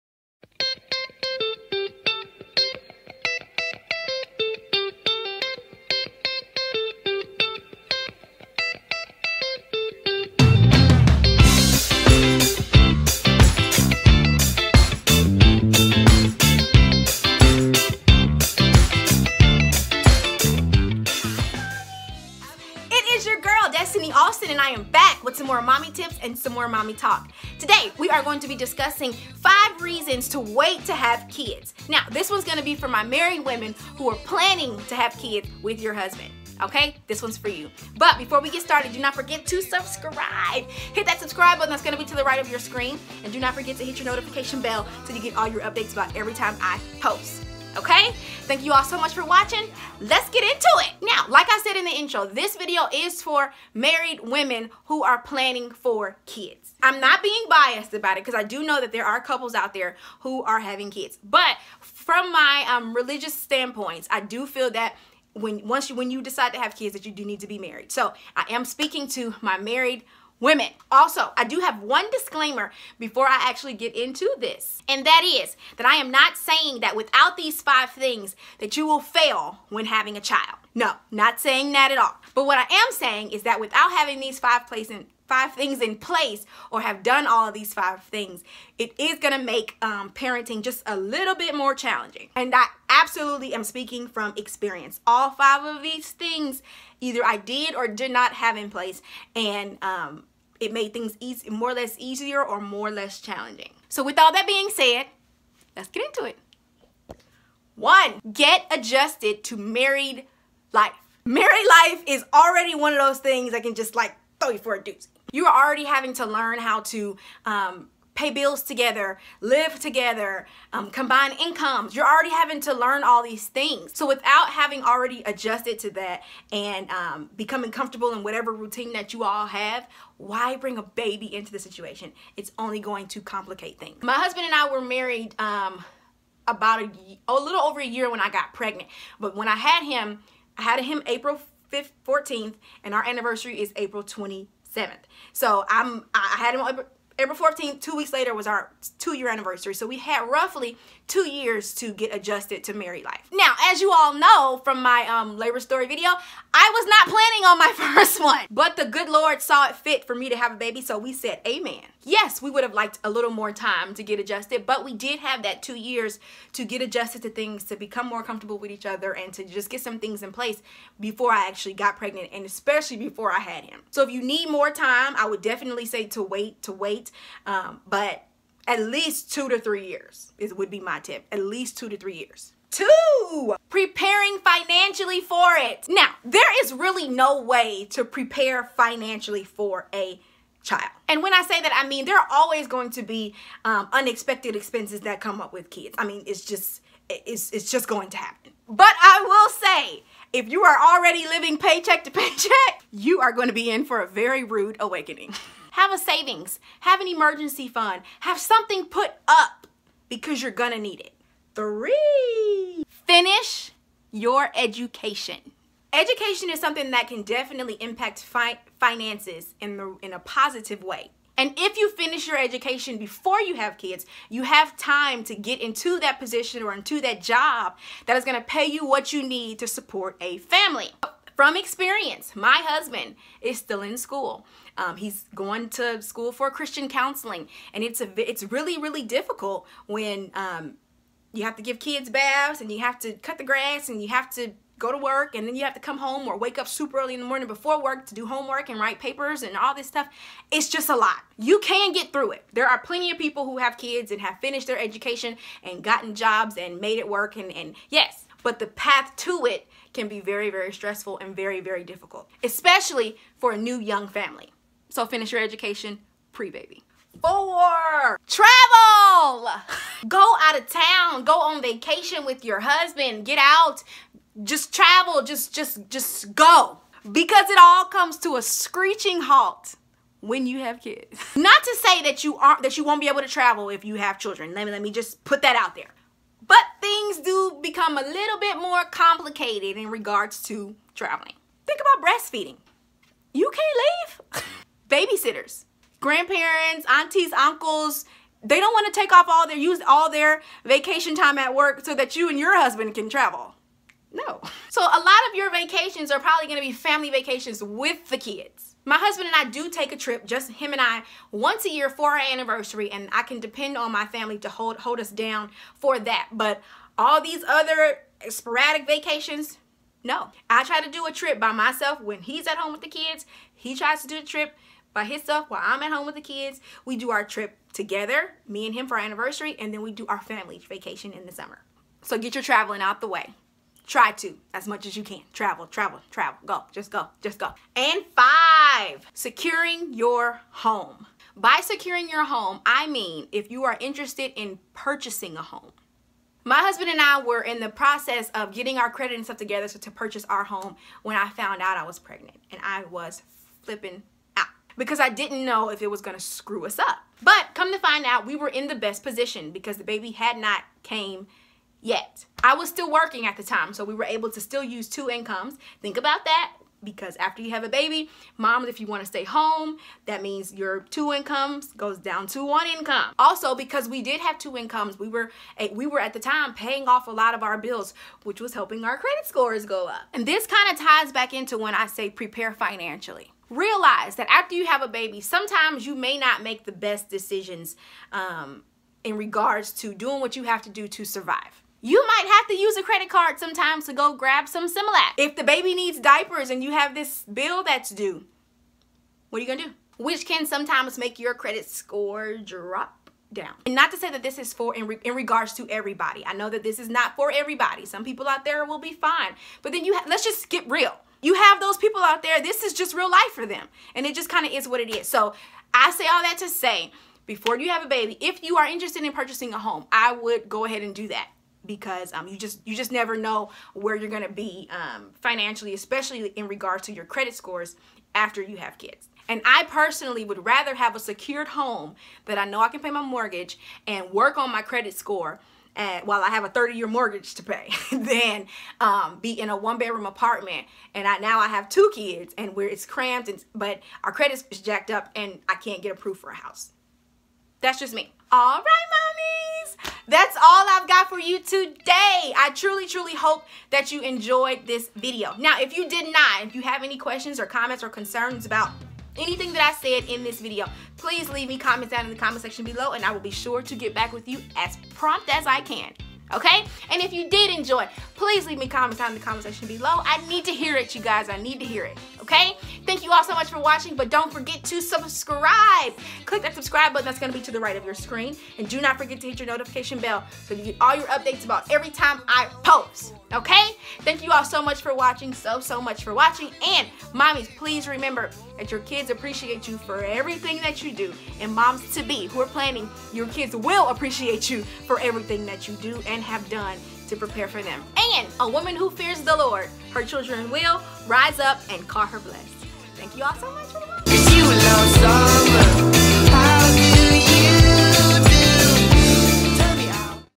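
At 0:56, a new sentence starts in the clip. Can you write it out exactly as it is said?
I'm not being biased about it because I do know that there are couples out there who are having kids.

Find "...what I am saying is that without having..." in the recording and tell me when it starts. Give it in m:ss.
1:22.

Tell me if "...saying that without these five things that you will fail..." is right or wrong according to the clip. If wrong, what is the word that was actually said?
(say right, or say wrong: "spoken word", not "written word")
right.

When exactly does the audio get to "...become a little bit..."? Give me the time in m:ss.
4:47.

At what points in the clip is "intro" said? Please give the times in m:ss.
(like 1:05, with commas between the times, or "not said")
0:51.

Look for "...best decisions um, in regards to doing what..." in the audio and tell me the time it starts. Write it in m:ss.
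6:26.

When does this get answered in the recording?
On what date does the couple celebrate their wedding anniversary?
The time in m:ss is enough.
2:23.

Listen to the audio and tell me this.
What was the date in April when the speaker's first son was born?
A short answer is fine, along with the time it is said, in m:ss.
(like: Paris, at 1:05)
April 14th, at 2:27.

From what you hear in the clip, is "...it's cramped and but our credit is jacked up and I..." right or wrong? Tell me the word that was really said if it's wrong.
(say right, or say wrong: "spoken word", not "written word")
right.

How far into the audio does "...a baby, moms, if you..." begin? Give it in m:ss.
6:07.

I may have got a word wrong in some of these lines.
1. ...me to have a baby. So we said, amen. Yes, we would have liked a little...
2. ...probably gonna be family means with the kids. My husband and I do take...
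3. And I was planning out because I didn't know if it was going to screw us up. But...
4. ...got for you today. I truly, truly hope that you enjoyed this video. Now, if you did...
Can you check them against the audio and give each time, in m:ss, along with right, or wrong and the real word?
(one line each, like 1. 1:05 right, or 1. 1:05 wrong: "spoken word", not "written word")
1. 2:40 right
2. 5:06 wrong: "vacations", not "means"
3. 5:52 wrong: "flipping", not "planning"
4. 7:30 right.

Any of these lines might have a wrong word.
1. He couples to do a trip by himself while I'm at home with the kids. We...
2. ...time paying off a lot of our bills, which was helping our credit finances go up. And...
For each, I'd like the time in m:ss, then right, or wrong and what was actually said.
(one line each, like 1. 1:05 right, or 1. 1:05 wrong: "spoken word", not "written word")
1. 5:23 wrong: "tries", not "couples"
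2. 6:16 wrong: "scores", not "finances".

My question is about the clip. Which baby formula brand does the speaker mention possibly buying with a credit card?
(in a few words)
Similac.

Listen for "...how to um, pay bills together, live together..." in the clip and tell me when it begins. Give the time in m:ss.
1:56.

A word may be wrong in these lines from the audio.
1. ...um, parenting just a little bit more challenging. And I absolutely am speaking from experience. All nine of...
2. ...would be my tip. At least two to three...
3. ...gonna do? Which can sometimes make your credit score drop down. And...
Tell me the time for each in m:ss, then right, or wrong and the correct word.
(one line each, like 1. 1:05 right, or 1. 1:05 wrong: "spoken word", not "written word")
1. 1:29 wrong: "five", not "nine"
2. 3:00 right
3. 6:39 right.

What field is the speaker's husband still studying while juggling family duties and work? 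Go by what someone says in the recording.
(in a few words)
Christian counseling.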